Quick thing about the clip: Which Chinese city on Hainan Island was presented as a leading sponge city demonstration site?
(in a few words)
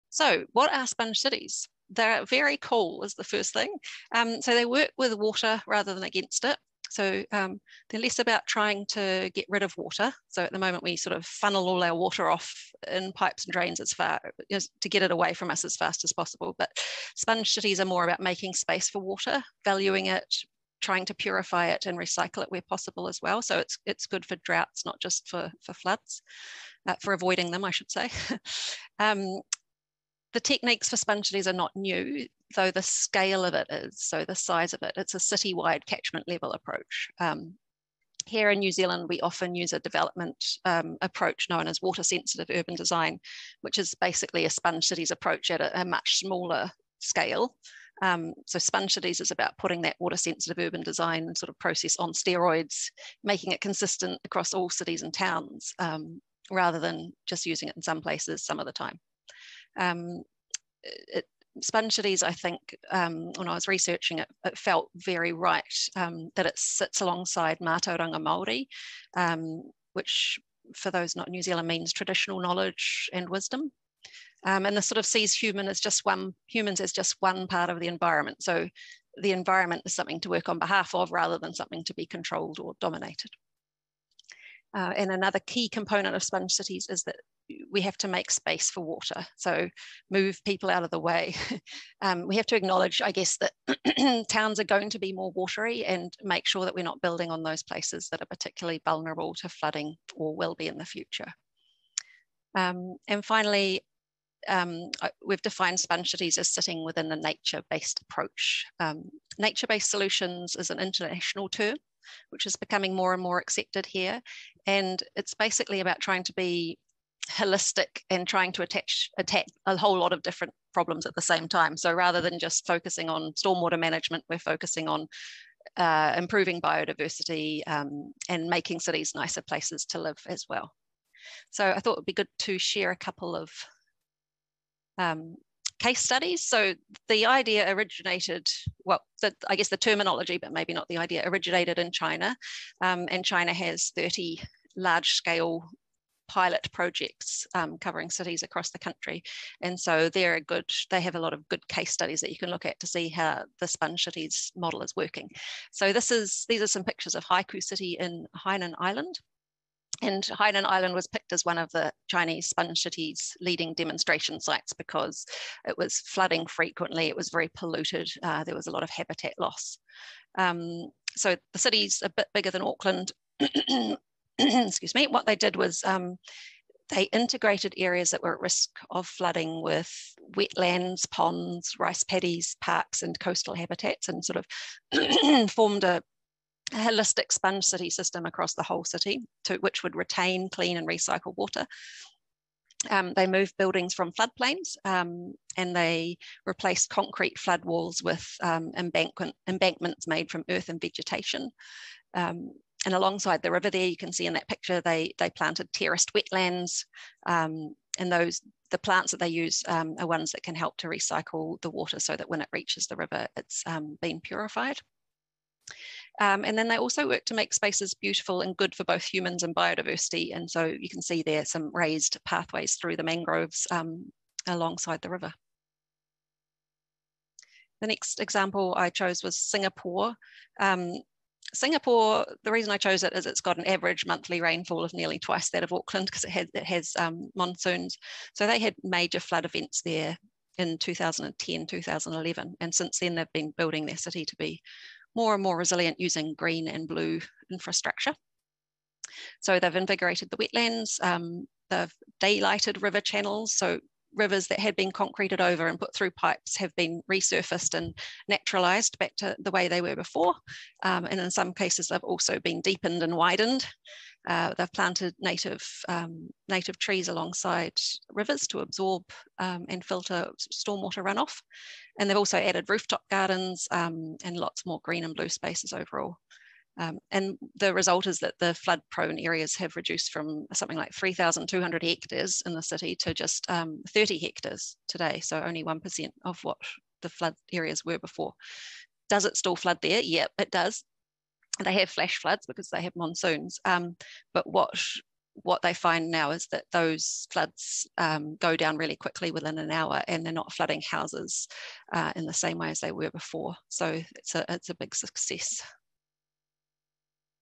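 Haiku City.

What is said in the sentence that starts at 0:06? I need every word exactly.
So um, they're less about trying to get rid of water.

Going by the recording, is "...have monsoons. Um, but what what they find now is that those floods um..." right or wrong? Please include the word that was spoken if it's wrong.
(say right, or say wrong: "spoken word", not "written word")
right.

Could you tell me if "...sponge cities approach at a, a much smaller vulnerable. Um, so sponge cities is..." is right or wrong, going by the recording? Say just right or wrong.
wrong.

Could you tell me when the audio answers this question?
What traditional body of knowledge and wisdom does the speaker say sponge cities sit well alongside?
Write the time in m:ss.
1:07.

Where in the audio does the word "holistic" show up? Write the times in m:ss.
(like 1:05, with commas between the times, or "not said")
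1:57, 3:06.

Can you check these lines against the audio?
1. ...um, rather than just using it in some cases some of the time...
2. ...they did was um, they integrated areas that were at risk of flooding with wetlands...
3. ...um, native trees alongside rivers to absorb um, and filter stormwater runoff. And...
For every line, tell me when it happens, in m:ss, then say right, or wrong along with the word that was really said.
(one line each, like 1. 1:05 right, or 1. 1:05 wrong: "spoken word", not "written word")
1. 0:55 wrong: "places", not "cases"
2. 2:55 right
3. 4:25 right.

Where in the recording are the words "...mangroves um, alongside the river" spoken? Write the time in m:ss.
3:43.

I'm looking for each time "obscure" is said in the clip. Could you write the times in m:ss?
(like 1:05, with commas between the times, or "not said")
not said.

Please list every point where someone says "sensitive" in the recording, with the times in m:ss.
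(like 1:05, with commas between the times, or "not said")
0:42, 0:50.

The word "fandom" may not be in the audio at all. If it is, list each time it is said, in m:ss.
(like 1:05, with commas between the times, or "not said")
not said.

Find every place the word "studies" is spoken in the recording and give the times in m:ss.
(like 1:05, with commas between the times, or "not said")
2:15, 2:31.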